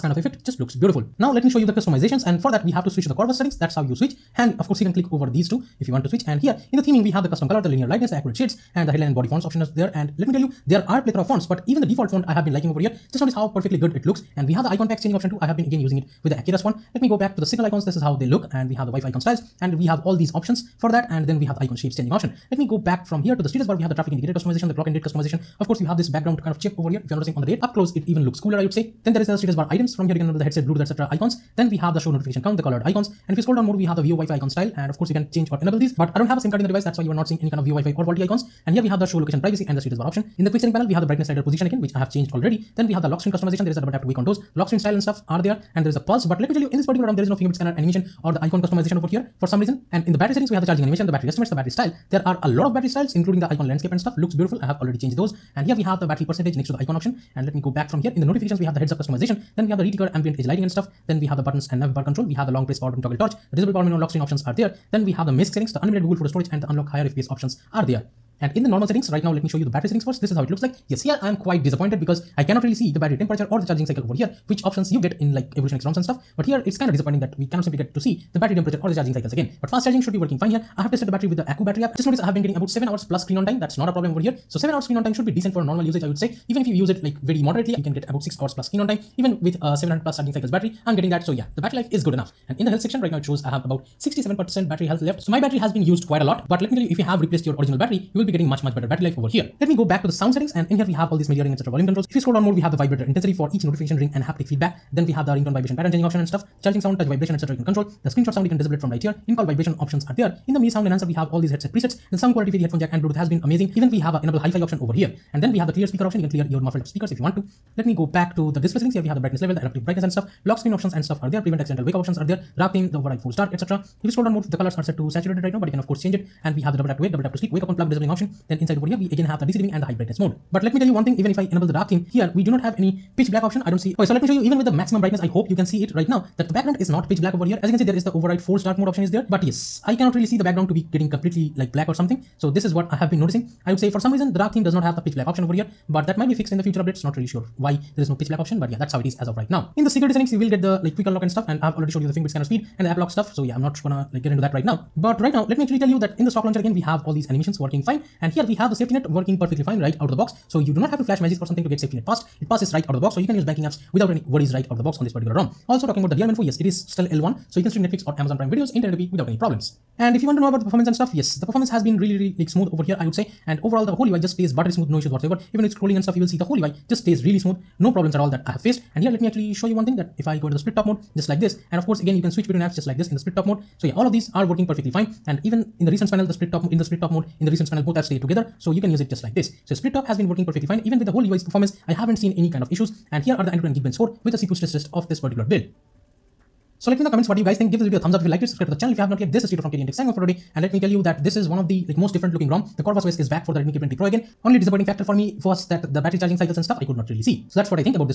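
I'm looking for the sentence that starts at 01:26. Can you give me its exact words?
Even if you use it like very moderately, you can get about 6 hours plus screen on time.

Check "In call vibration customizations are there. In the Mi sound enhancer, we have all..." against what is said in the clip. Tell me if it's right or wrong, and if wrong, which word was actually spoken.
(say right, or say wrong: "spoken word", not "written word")
wrong: "options", not "customizations".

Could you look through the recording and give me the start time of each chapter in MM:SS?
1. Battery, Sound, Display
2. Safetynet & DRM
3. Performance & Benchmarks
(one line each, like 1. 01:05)
1. 01:08
2. 02:35
3. 02:49.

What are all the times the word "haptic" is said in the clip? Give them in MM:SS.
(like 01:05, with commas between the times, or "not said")
01:44.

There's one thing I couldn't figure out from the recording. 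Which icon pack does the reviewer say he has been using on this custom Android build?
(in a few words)
Acherus.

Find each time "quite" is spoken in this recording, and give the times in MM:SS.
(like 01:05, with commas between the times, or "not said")
01:11, 01:36.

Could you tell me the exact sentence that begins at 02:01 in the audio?
Prevent accidental wake up options are there.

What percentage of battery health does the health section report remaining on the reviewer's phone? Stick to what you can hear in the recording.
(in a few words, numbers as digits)
67%.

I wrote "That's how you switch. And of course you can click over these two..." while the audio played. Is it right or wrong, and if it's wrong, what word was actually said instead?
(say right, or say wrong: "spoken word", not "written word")
right.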